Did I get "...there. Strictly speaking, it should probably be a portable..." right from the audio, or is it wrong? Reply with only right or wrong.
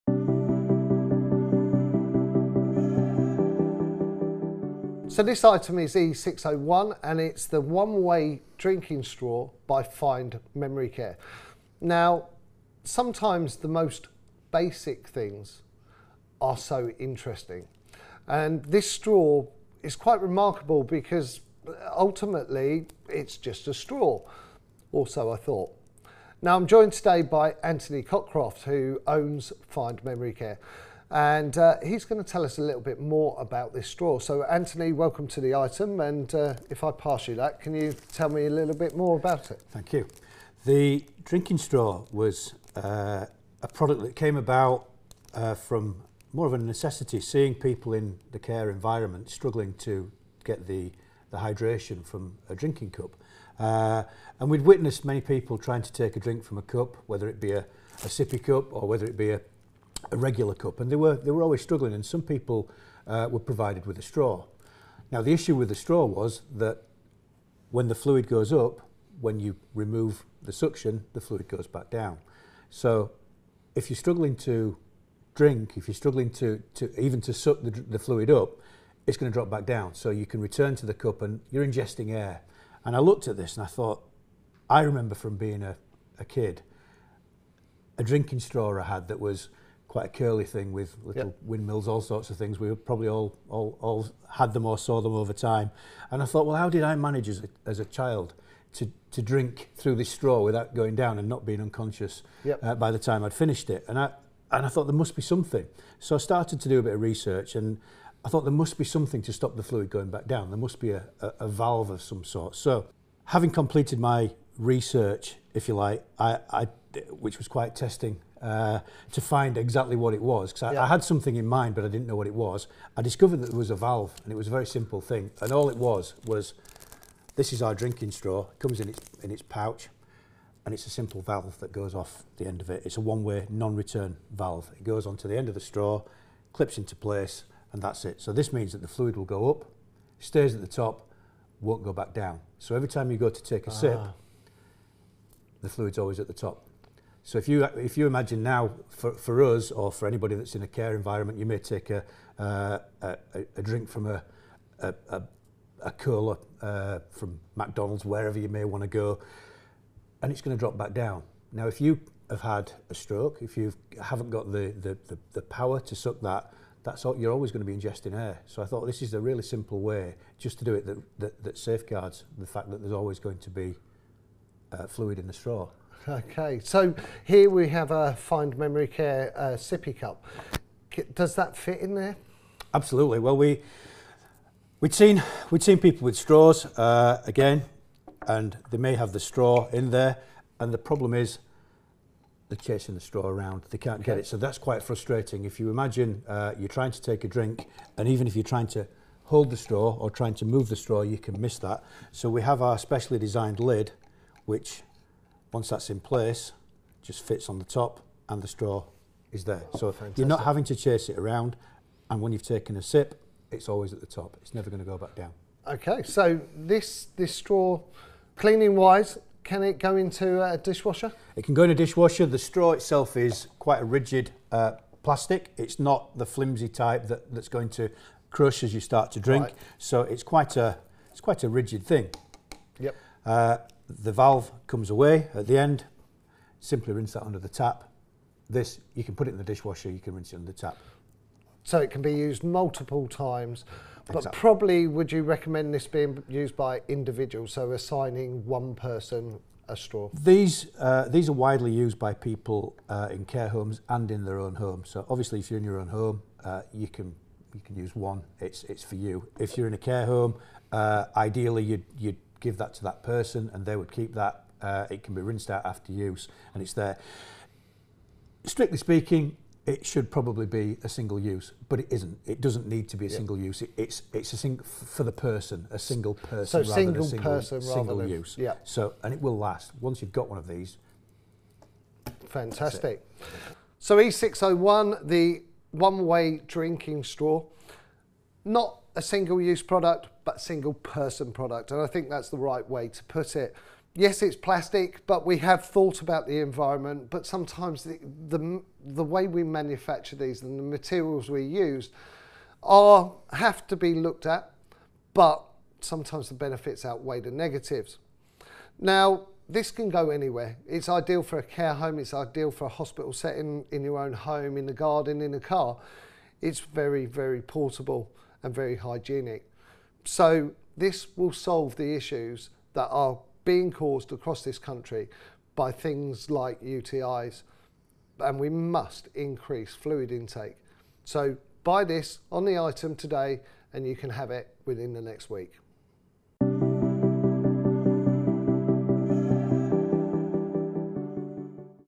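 wrong.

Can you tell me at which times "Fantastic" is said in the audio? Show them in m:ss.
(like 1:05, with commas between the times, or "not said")
3:29, 4:42.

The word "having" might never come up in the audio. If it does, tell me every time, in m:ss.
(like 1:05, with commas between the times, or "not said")
1:53, 3:30.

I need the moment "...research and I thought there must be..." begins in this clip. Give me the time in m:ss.
1:47.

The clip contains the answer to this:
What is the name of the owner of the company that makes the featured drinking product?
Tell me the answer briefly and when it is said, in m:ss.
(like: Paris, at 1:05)
Anthony Cockcroft, at 0:27.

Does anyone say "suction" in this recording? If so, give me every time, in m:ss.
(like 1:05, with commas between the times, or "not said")
1:10.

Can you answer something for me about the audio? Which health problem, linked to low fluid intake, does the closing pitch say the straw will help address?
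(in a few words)
UTIs.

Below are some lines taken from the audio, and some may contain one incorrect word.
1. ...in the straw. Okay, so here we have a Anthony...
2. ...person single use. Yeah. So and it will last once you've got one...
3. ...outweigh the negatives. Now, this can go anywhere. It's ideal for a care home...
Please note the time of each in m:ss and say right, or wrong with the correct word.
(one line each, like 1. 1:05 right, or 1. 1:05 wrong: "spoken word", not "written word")
1. 2:55 wrong: "Find", not "Anthony"
2. 4:37 right
3. 5:06 right.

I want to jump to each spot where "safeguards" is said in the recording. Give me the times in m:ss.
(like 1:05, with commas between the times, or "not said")
2:51.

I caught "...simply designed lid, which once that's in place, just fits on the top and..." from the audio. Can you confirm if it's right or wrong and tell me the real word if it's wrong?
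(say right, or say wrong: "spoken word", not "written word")
wrong: "specially", not "simply".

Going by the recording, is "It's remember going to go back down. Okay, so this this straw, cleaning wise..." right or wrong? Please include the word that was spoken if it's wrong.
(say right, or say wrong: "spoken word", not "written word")
wrong: "never", not "remember".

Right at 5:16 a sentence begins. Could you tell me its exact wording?
It's very, very portable and very hygienic.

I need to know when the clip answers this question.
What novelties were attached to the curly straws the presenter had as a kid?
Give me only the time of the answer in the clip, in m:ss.
1:31.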